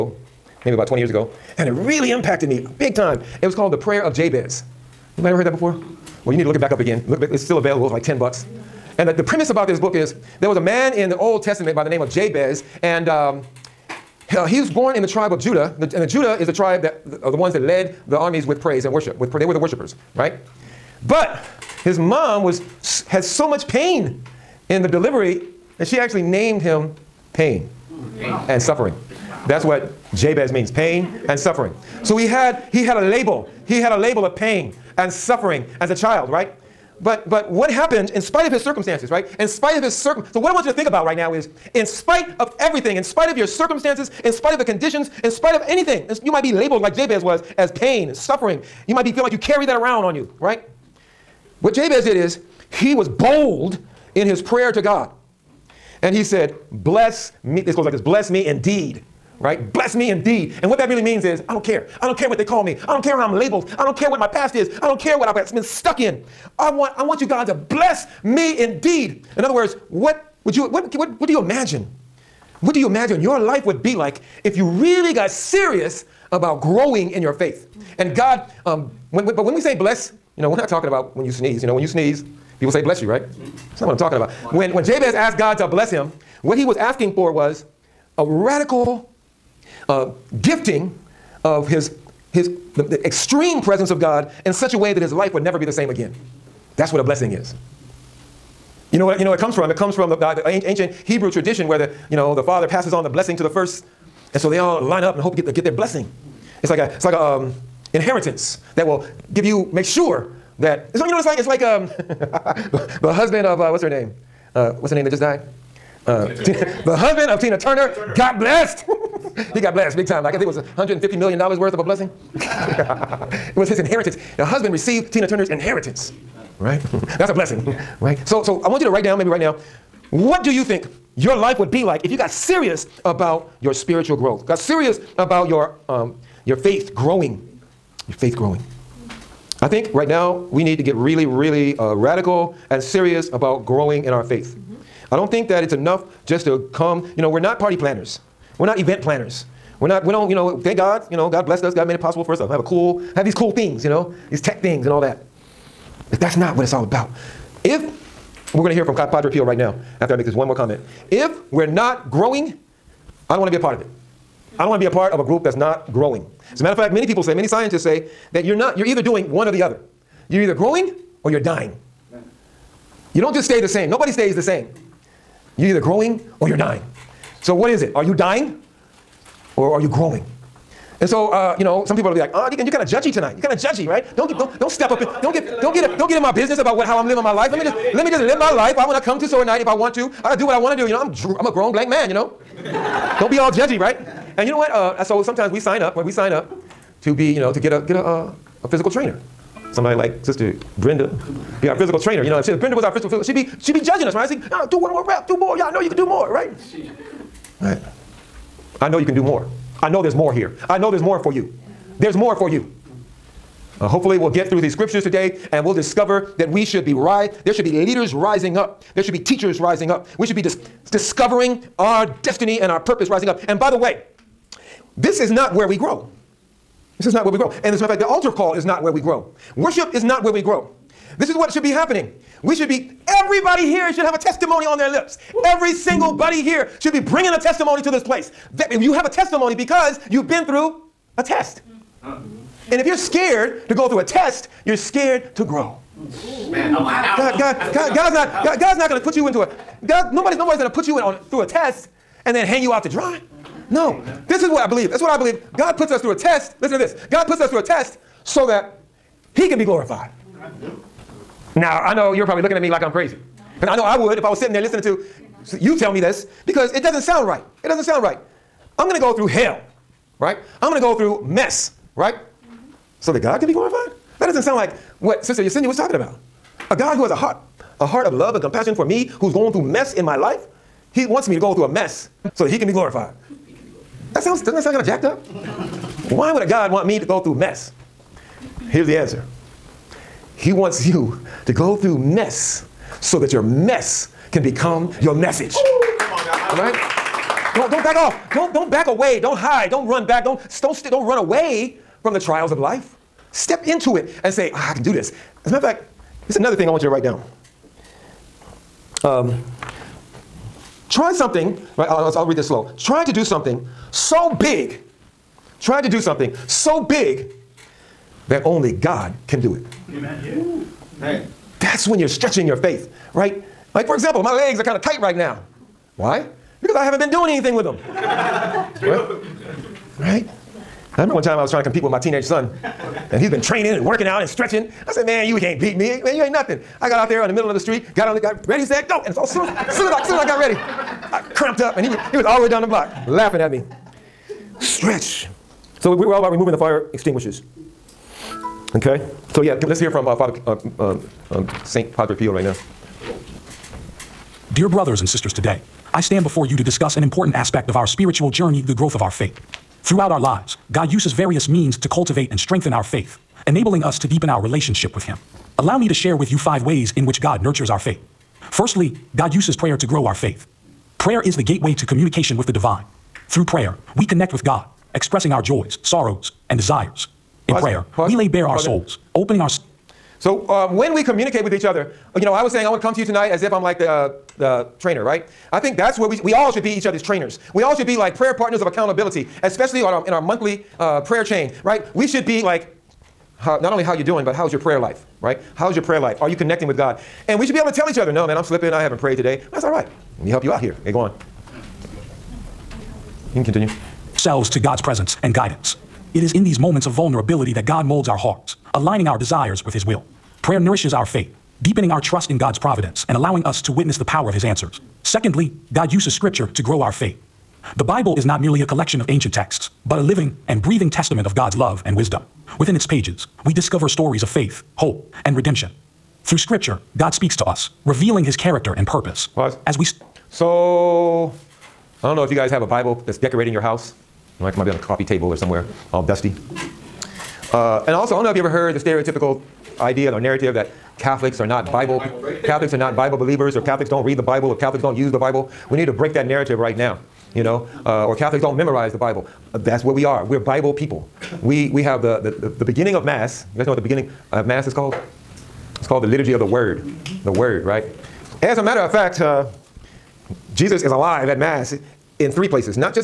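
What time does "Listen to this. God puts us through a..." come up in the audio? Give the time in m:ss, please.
4:16.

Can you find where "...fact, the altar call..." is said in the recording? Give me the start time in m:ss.
3:47.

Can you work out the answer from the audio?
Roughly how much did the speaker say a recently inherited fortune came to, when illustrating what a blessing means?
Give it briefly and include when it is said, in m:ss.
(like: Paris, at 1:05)
$150 million, at 2:00.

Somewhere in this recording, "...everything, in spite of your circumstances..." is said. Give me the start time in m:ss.
0:42.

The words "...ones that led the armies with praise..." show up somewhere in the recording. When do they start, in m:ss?
0:17.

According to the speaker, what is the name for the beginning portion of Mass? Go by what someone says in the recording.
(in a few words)
Liturgy of the Word.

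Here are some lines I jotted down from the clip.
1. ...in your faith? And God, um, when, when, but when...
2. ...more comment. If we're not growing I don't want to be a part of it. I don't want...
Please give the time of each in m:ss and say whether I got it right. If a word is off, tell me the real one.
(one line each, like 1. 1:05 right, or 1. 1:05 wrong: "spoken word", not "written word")
1. 1:17 right
2. 2:40 right.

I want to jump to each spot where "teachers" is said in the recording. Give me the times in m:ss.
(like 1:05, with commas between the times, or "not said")
3:39.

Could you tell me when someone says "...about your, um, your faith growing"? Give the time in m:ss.
2:15.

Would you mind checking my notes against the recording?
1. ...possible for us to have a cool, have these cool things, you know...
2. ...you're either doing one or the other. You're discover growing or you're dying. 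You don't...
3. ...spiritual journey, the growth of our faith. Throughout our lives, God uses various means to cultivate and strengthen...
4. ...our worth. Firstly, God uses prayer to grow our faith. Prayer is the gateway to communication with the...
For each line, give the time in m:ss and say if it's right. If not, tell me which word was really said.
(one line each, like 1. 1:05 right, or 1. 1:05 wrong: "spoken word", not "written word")
1. 2:32 right
2. 2:48 wrong: "either", not "discover"
3. 5:57 right
4. 6:07 wrong: "faith", not "worth".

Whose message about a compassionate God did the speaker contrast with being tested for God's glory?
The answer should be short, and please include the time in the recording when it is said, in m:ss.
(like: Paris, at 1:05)
Sister Yesenia, at 4:35.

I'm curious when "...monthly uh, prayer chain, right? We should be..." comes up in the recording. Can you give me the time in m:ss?
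6:30.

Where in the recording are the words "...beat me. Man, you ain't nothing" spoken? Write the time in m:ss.
5:35.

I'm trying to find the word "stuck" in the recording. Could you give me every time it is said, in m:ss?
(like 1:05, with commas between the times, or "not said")
1:05.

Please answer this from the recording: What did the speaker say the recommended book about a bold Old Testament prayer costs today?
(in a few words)
10 bucks.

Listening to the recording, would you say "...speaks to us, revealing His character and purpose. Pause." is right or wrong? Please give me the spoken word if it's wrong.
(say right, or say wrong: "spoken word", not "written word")
right.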